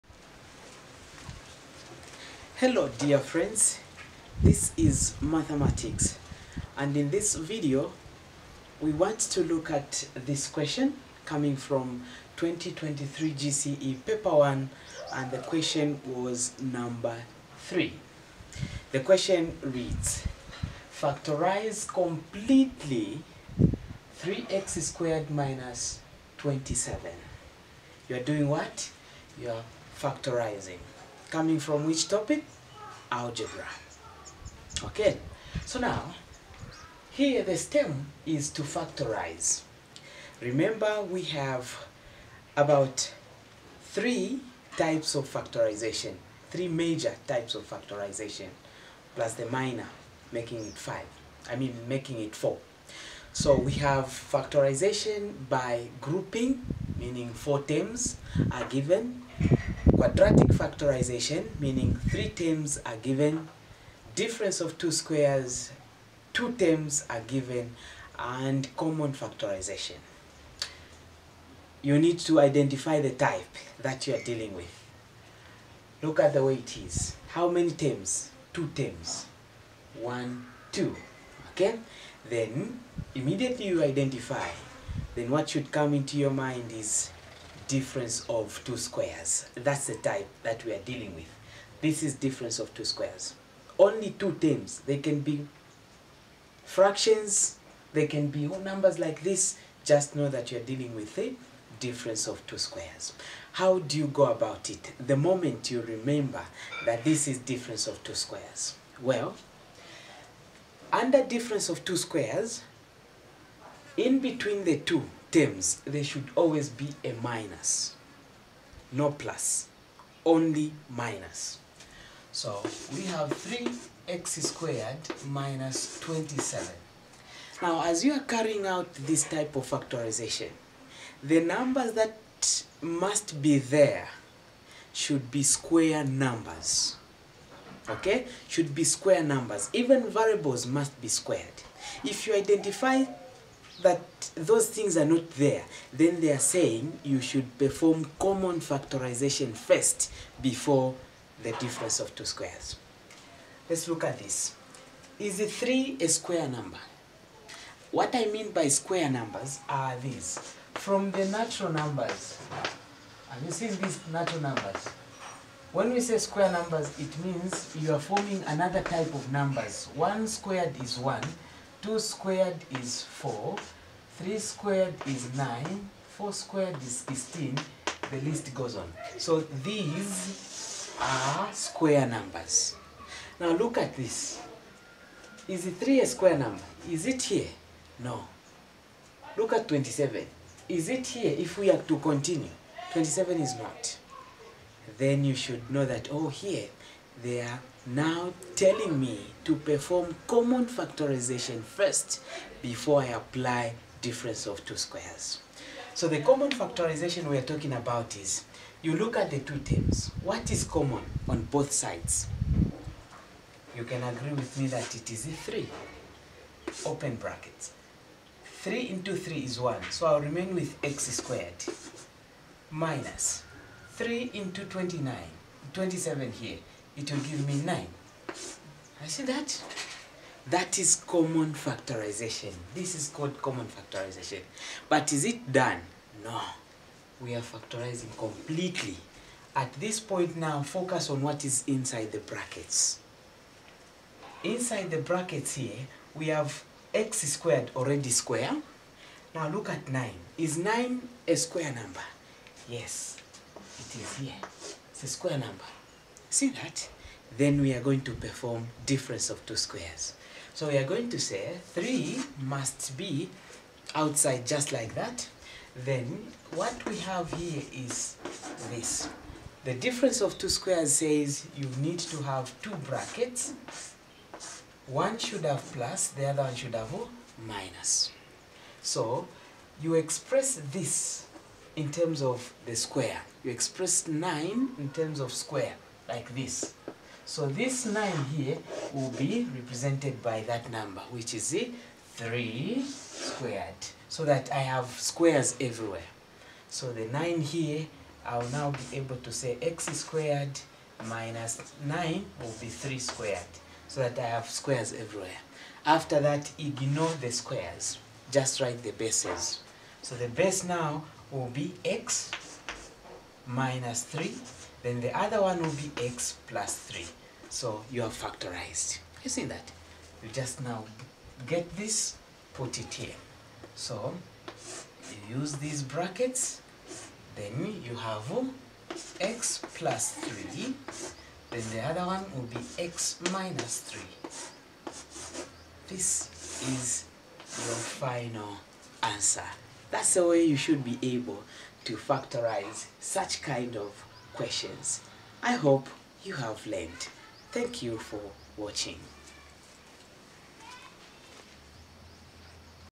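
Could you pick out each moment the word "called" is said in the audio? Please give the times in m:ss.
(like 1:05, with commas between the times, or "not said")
3:53.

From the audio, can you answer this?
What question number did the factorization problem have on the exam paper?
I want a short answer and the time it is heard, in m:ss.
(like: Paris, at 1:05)
3, at 0:16.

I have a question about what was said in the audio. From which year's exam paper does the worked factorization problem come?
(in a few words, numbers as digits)
2023.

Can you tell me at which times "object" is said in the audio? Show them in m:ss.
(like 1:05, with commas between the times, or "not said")
not said.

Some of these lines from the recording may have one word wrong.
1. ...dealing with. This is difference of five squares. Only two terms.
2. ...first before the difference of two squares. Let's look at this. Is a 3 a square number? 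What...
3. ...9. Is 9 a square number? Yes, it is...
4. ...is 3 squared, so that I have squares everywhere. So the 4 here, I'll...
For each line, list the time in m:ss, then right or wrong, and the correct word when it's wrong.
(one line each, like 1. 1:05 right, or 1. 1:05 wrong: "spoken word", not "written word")
1. 1:30 wrong: "two", not "five"
2. 2:29 right
3. 4:09 right
4. 4:51 wrong: "9", not "4".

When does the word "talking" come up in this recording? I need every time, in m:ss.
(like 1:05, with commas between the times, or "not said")
3:27.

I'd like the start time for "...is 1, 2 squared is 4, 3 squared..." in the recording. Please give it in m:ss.
2:50.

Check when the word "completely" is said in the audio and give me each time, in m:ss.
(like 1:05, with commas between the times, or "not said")
0:21, 3:58.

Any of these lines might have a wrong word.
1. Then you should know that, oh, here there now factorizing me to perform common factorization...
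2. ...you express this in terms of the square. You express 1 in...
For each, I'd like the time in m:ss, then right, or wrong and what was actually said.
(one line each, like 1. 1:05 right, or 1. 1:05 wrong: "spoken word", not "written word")
1. 3:14 wrong: "telling", not "factorizing"
2. 4:39 wrong: "9", not "1".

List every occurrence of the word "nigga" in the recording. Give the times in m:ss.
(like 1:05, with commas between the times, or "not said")
not said.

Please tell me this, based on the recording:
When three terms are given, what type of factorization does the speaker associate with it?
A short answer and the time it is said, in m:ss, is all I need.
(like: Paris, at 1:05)
Quadratic factorization, at 1:00.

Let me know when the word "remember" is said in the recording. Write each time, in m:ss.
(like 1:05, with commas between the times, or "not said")
0:40, 1:45.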